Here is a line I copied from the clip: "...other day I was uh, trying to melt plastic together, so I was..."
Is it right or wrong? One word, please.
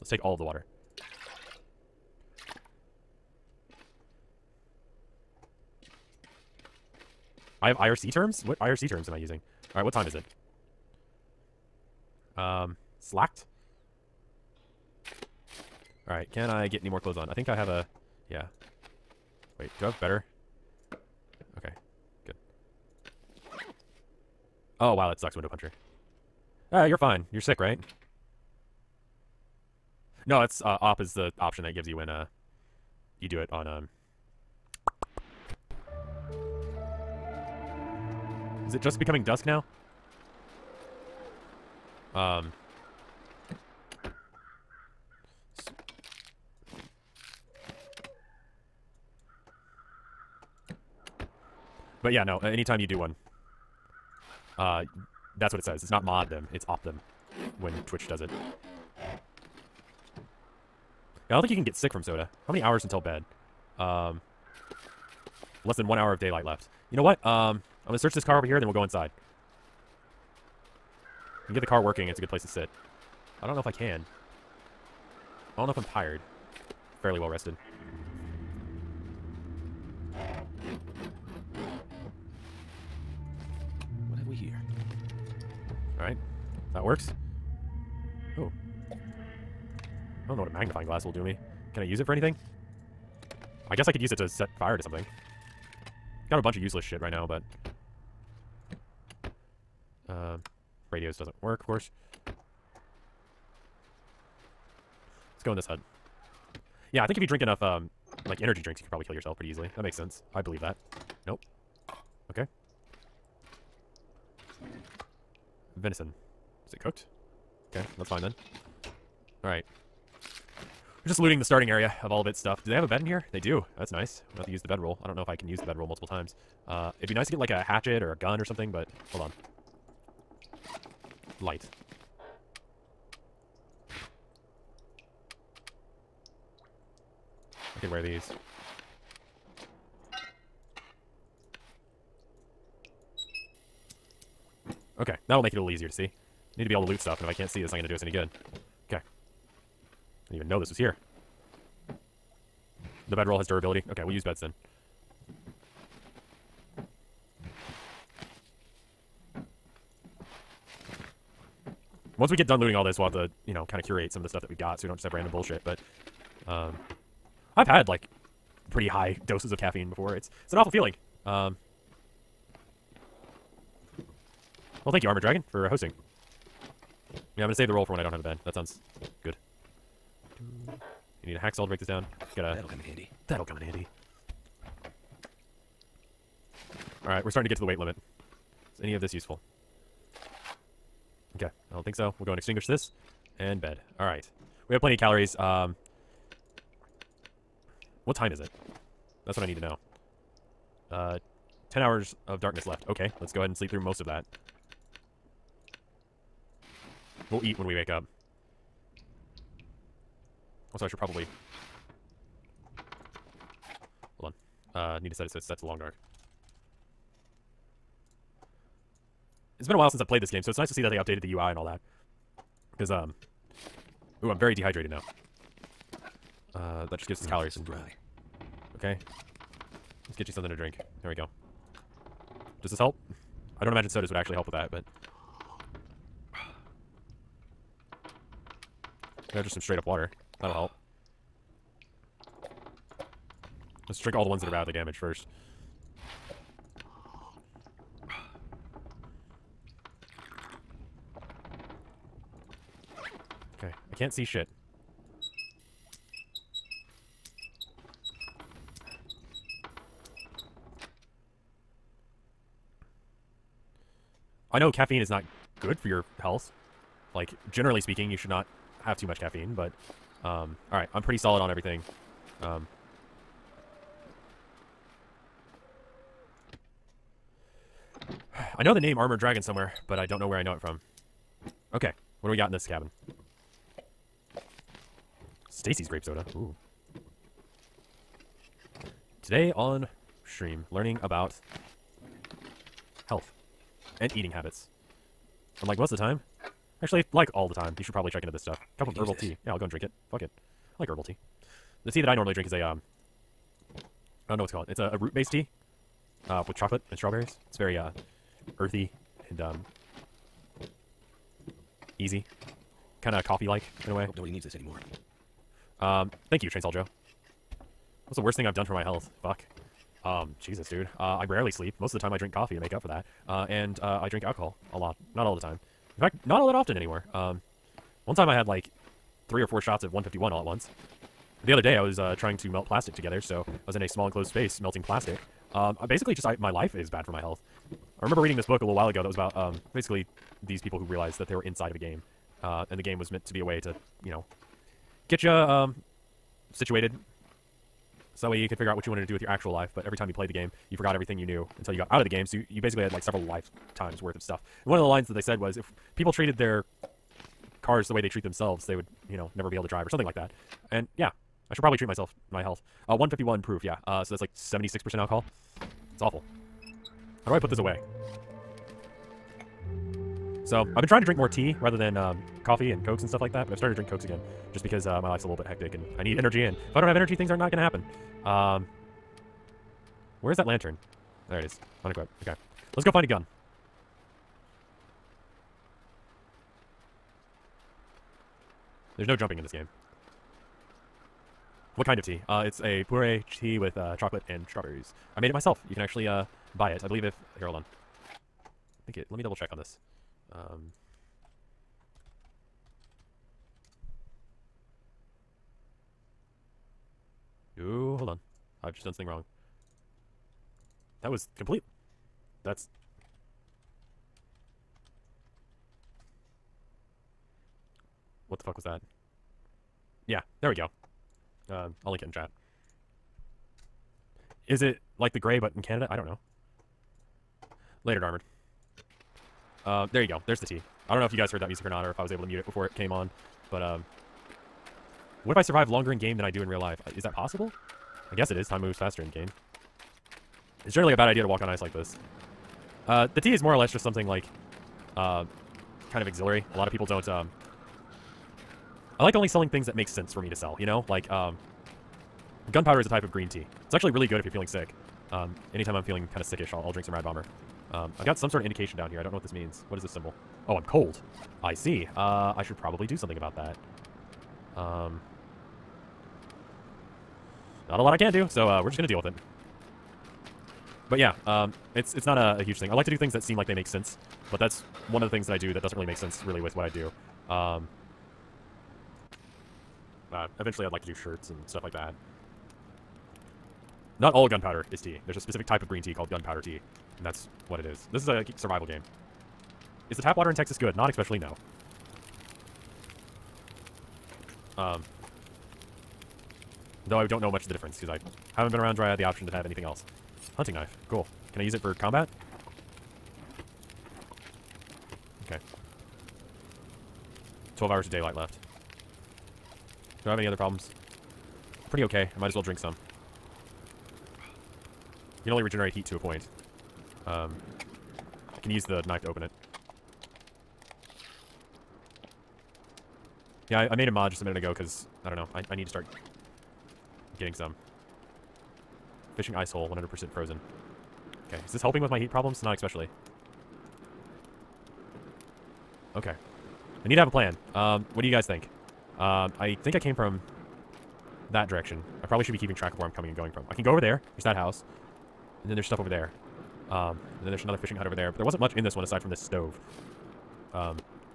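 right.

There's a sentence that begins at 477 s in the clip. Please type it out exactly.
Um, uh, eventually I'd like to do shirts and stuff like that.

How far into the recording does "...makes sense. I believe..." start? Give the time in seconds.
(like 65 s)
109 s.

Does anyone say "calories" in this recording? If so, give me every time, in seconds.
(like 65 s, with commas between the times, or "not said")
194 s, 227 s.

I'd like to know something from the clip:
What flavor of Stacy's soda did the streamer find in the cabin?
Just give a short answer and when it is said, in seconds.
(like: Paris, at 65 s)
Grape, at 285 s.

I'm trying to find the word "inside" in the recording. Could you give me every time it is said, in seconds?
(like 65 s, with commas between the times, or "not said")
68 s, 341 s.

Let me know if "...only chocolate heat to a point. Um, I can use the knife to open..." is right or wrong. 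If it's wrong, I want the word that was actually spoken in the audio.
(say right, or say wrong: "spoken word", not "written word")
wrong: "regenerate", not "chocolate".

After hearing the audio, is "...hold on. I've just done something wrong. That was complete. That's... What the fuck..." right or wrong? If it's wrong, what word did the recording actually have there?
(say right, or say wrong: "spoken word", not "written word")
right.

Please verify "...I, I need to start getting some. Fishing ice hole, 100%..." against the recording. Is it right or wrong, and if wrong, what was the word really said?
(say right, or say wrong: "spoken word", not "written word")
right.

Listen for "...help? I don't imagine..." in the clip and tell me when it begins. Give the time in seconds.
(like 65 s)
232 s.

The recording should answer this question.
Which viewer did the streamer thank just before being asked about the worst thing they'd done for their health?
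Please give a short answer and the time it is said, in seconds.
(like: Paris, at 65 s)
Trainsaw Joe, at 316 s.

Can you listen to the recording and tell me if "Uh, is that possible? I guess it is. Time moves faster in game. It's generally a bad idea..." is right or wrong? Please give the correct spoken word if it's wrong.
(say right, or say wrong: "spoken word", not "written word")
right.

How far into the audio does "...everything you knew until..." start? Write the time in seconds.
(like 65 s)
350 s.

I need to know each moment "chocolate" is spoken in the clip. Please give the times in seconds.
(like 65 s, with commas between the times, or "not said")
306 s, 393 s.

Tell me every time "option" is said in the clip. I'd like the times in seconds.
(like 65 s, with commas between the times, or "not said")
31 s, 499 s.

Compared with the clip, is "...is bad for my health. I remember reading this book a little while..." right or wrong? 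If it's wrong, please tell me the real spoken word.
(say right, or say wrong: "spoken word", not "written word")
right.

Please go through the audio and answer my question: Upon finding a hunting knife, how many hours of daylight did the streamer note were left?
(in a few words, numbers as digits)
12.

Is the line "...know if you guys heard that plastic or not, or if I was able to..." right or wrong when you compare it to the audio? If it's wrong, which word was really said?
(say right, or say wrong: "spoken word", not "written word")
wrong: "music", not "plastic".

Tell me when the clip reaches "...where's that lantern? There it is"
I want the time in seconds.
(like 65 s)
380 s.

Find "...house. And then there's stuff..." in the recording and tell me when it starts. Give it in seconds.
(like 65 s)
544 s.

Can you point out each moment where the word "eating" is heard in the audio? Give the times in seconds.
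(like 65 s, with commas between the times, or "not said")
294 s.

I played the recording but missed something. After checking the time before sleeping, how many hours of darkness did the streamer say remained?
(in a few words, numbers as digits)
10.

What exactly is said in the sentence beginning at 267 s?
Like, generally speaking, you should not have too much caffeine, but...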